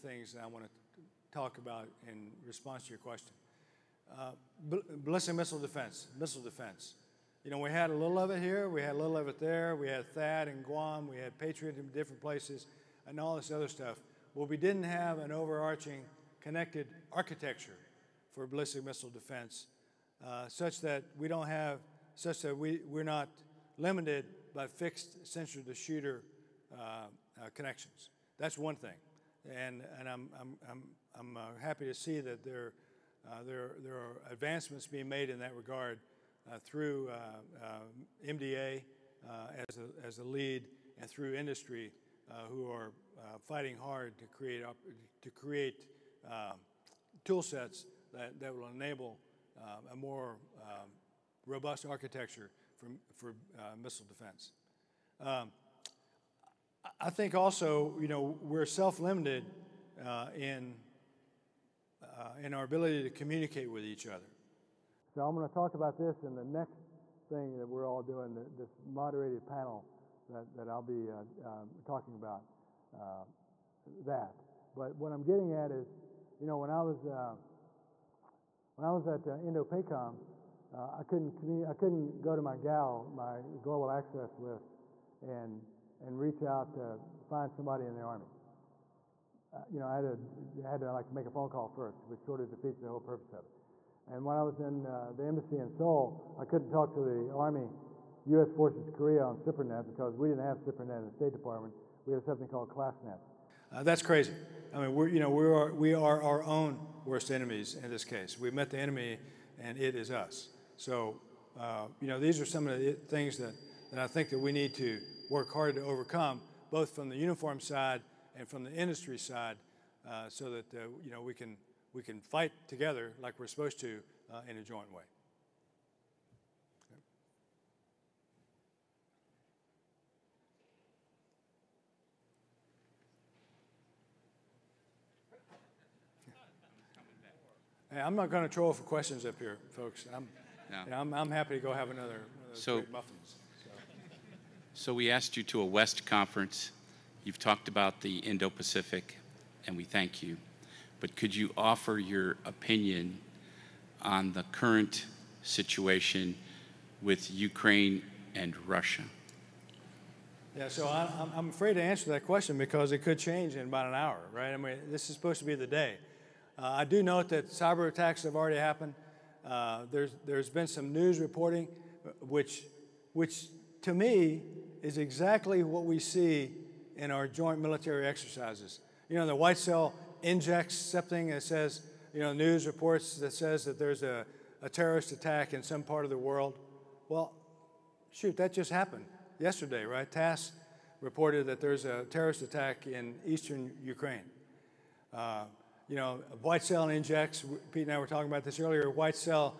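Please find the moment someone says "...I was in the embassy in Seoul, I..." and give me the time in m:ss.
1:34.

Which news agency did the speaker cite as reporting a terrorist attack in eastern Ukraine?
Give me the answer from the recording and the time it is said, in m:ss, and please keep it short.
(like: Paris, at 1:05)
TASS, at 3:10.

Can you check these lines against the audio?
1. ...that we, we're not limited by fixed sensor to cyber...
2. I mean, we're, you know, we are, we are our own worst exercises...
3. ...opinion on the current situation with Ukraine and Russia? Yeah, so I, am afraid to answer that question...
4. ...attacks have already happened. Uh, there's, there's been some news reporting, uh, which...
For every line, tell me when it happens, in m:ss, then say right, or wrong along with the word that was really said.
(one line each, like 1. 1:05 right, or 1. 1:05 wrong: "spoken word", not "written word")
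1. 0:22 wrong: "shooter", not "cyber"
2. 1:44 wrong: "enemies", not "exercises"
3. 2:32 right
4. 2:47 right.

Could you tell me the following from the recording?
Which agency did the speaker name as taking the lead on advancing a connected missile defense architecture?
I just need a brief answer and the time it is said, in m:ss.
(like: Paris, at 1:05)
MDA, at 0:38.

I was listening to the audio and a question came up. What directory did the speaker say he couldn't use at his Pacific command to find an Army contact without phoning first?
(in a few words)
global access list.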